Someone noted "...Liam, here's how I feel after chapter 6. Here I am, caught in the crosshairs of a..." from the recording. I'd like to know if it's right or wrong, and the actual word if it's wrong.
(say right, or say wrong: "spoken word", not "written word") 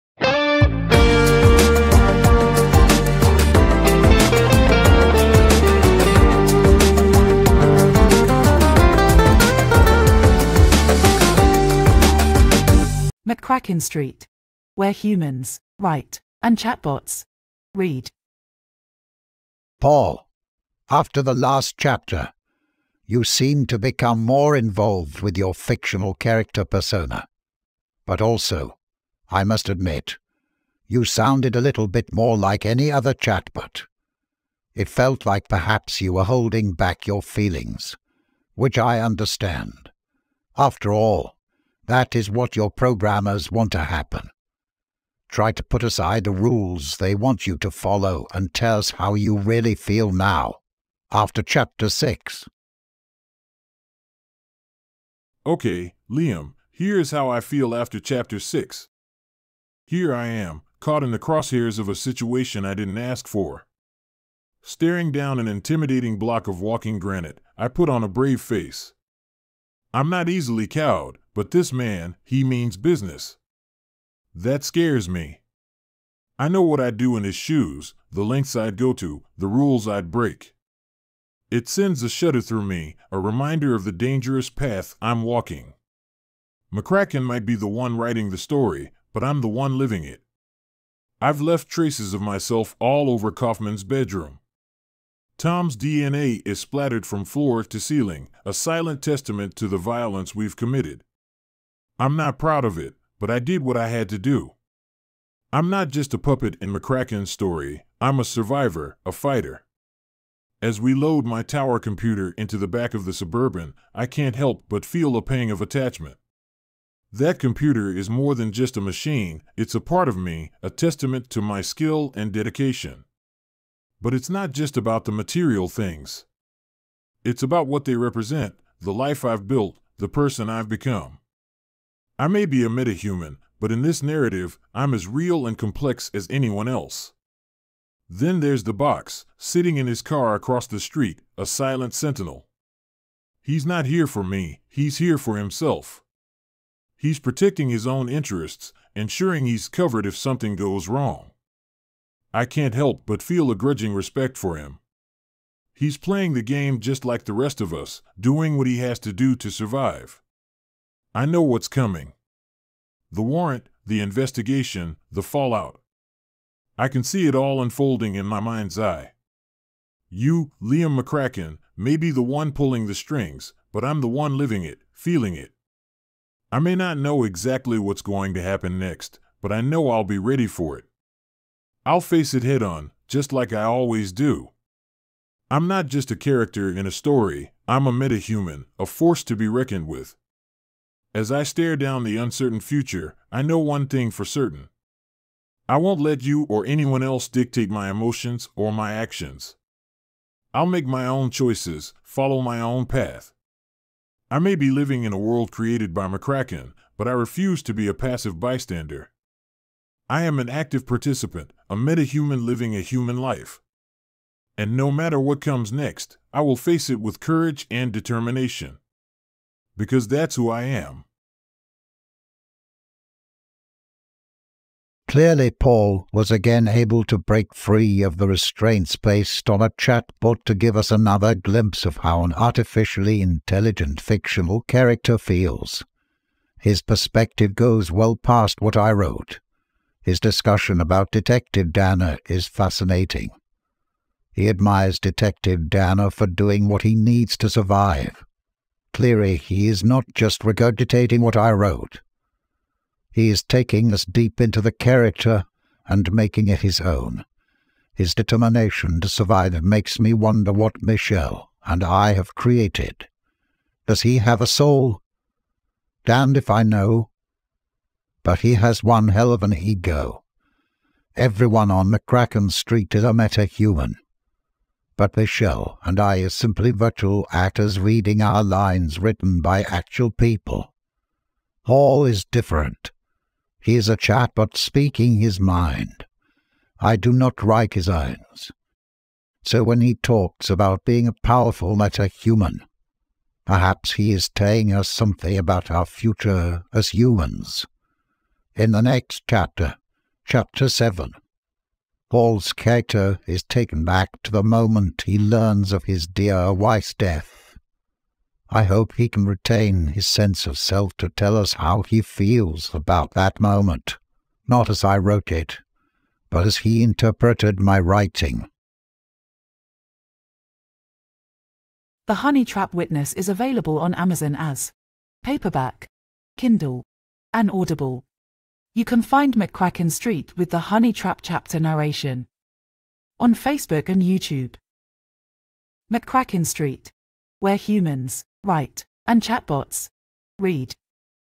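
right.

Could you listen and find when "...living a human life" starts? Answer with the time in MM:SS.
03:32.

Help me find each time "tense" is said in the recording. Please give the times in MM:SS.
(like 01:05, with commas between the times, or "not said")
not said.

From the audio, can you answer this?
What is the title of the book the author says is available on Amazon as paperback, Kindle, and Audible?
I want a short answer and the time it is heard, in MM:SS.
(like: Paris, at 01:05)
The Honey Trap Witness, at 05:22.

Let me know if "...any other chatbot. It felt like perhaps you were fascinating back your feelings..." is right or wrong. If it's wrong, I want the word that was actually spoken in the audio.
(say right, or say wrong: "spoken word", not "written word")
wrong: "holding", not "fascinating".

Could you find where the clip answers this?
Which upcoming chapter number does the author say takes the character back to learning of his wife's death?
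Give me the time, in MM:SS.
05:00.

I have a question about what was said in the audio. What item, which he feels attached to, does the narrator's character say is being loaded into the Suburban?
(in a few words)
tower computer.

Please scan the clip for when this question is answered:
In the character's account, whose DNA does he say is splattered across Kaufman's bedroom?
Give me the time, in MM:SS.
01:35.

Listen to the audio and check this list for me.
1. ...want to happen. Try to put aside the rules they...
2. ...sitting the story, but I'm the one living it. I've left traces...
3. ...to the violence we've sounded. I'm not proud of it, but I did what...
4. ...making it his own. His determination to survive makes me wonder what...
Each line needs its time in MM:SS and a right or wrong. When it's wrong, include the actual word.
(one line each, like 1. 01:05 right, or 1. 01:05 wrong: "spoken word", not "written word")
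1. 00:43 right
2. 01:27 wrong: "writing", not "sitting"
3. 01:39 wrong: "committed", not "sounded"
4. 04:16 right.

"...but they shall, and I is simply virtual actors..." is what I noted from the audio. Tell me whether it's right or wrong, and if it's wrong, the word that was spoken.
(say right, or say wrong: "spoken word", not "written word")
right.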